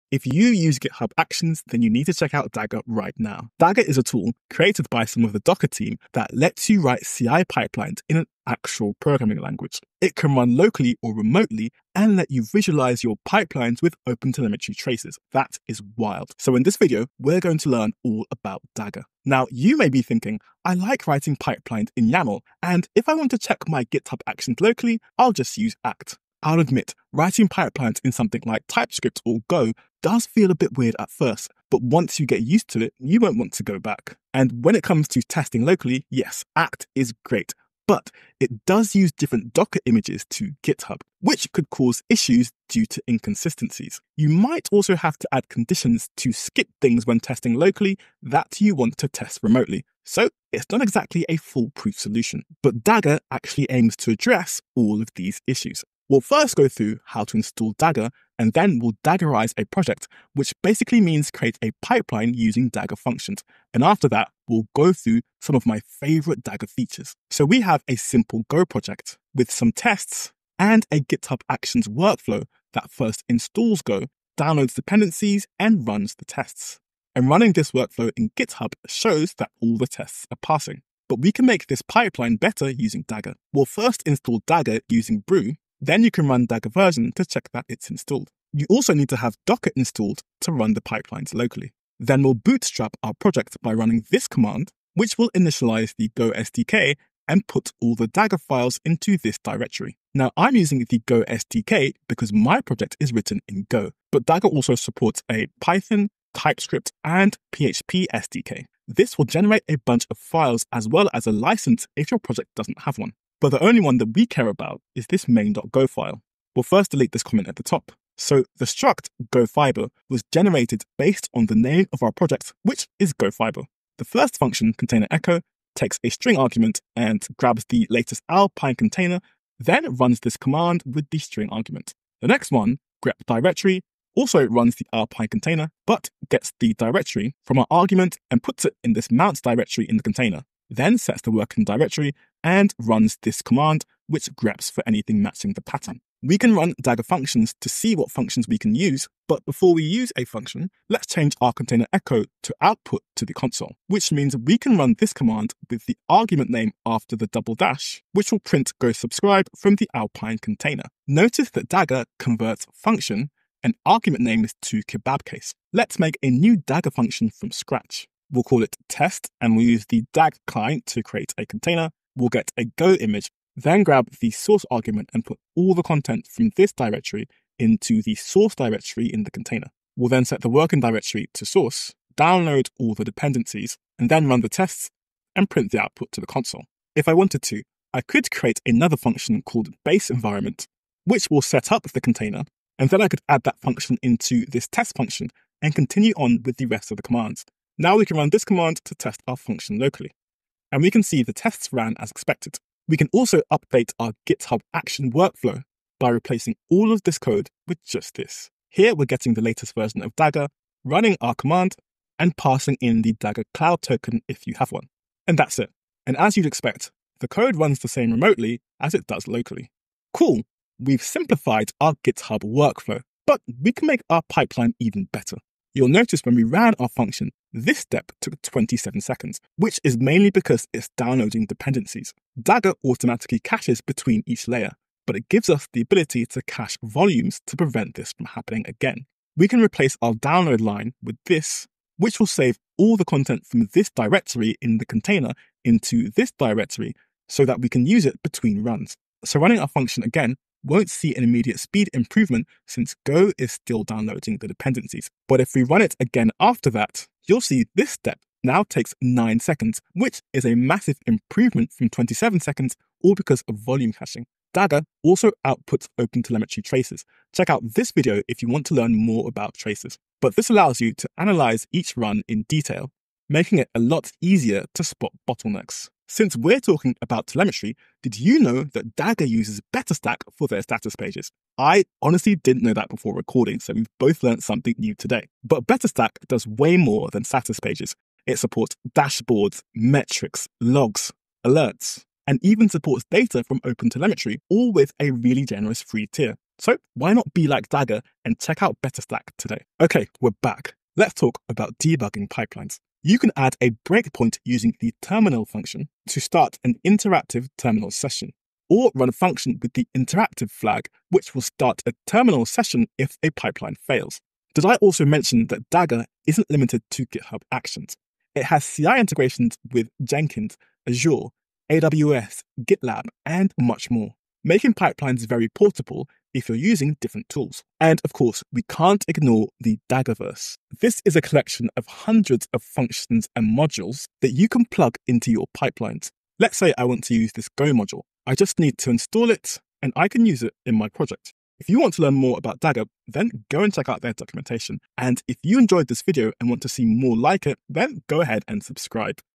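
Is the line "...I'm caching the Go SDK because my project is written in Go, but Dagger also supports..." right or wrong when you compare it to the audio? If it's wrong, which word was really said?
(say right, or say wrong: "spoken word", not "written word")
wrong: "using", not "caching".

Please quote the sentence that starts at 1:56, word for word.
We'll first delete this comment at the top.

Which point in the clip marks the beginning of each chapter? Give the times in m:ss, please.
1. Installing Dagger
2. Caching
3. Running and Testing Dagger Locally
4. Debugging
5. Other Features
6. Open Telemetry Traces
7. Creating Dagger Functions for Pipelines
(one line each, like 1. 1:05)
1. 1:10
2. 3:47
3. 3:19
4. 5:04
5. 5:23
6. 4:36
7. 2:12.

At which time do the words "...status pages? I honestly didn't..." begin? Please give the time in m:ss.
4:40.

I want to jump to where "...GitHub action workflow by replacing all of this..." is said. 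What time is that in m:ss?
3:24.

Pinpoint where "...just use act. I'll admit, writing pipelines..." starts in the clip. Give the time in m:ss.
0:25.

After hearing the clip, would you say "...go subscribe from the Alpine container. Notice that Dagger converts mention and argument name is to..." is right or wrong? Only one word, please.
wrong.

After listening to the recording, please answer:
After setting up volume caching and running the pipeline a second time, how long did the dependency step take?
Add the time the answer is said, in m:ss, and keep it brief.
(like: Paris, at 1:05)
9 seconds, at 4:19.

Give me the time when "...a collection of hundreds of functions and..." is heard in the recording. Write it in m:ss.
5:31.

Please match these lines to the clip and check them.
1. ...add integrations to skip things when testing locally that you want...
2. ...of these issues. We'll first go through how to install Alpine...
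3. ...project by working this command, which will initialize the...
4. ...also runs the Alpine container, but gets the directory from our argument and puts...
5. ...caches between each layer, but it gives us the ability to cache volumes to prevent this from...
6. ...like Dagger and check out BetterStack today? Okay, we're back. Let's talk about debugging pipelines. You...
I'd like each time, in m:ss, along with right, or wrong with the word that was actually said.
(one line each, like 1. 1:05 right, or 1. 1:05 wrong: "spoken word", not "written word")
1. 0:45 wrong: "conditions", not "integrations"
2. 0:55 wrong: "Dagger", not "Alpine"
3. 1:33 wrong: "running", not "working"
4. 2:14 right
5. 3:53 right
6. 4:57 right.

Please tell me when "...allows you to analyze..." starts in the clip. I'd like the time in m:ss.
4:30.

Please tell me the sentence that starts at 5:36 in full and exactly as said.
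Let's say I want to use this Go module.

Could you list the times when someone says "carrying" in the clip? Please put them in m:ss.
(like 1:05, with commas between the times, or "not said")
not said.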